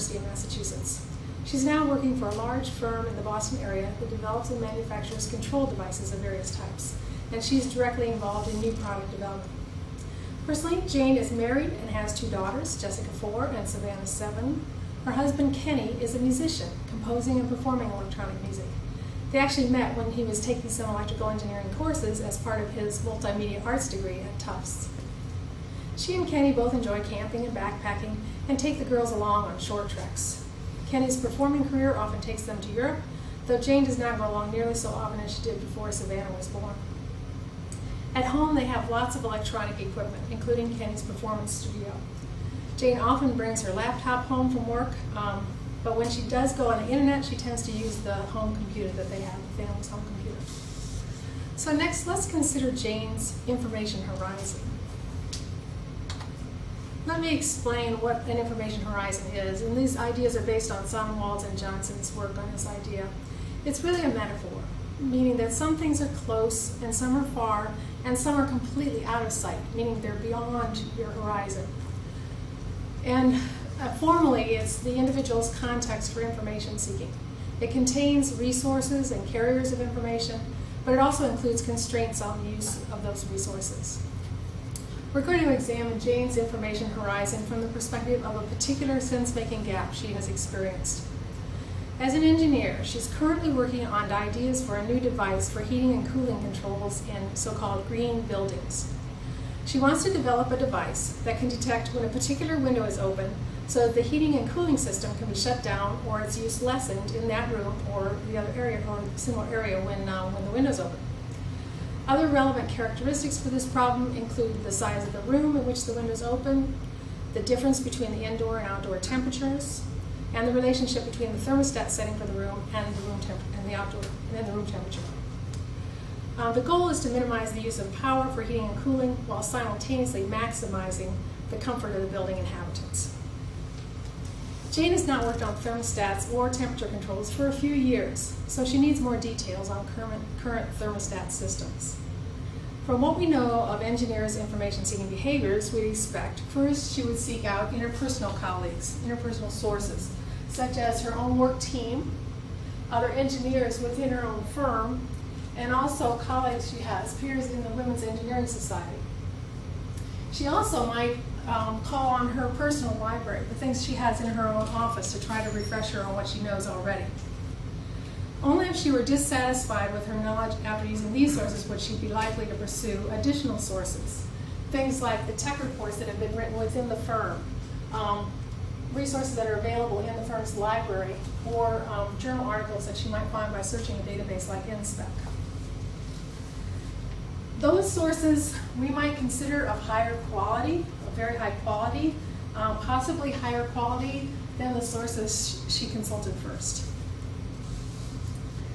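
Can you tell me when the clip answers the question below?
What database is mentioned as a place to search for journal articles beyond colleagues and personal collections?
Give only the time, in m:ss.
3:04.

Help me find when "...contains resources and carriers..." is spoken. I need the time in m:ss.
1:17.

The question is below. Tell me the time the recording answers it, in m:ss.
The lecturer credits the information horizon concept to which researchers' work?
1:01.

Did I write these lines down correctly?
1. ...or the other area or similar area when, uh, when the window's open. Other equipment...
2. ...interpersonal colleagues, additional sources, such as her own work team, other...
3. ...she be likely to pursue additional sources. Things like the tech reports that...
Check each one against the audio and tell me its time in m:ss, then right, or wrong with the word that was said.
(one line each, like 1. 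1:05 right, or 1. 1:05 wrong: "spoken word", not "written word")
1. 1:47 wrong: "relevant", not "equipment"
2. 2:27 wrong: "interpersonal", not "additional"
3. 2:51 right.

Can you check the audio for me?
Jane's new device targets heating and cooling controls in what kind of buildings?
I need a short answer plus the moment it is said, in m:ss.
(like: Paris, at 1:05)
green buildings, at 1:37.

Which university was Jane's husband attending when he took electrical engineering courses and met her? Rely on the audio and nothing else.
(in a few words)
Tufts.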